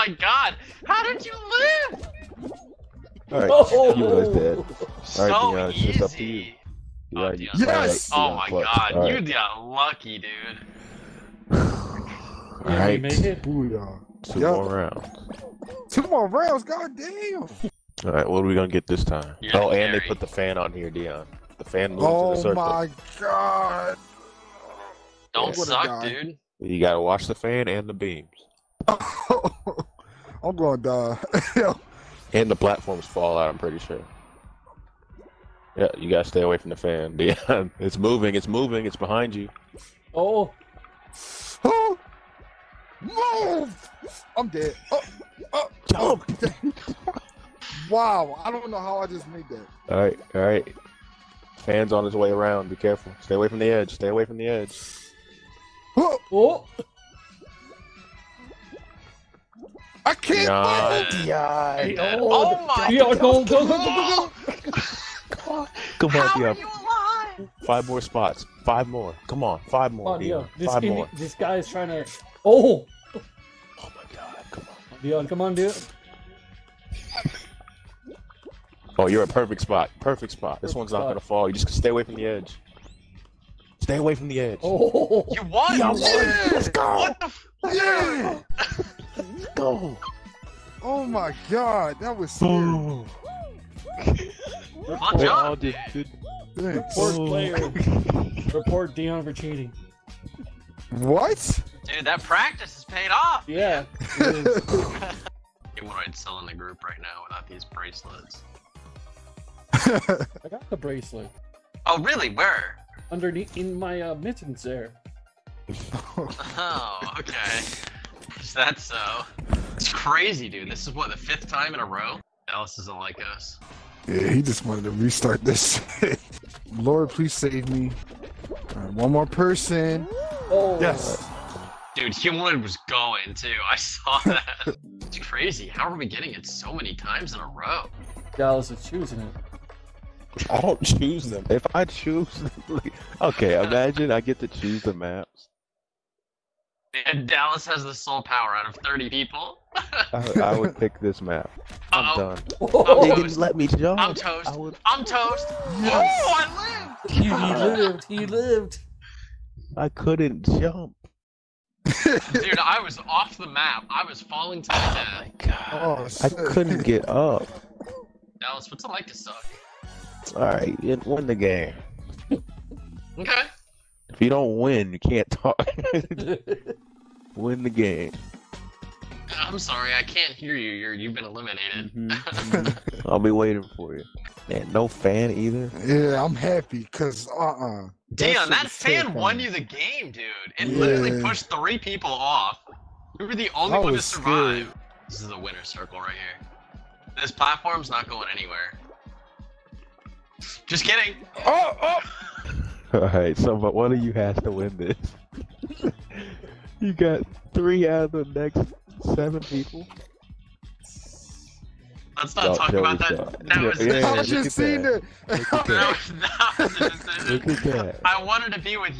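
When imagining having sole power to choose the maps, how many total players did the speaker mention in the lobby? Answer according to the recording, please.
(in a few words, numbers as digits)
30.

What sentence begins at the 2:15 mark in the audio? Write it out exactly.
How are we getting it so many times in a row?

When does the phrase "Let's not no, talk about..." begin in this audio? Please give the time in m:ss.
3:32.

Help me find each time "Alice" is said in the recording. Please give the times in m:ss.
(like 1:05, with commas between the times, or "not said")
2:02.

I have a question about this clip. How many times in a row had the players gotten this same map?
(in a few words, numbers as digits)
5th time.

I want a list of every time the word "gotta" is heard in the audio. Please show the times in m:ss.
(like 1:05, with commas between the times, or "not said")
0:26, 0:36.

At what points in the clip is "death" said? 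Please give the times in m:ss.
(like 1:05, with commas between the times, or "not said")
2:44.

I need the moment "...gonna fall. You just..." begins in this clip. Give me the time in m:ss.
1:21.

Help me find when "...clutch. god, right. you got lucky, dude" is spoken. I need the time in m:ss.
0:08.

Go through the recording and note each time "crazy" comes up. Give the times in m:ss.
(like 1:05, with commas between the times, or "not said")
1:59, 2:15.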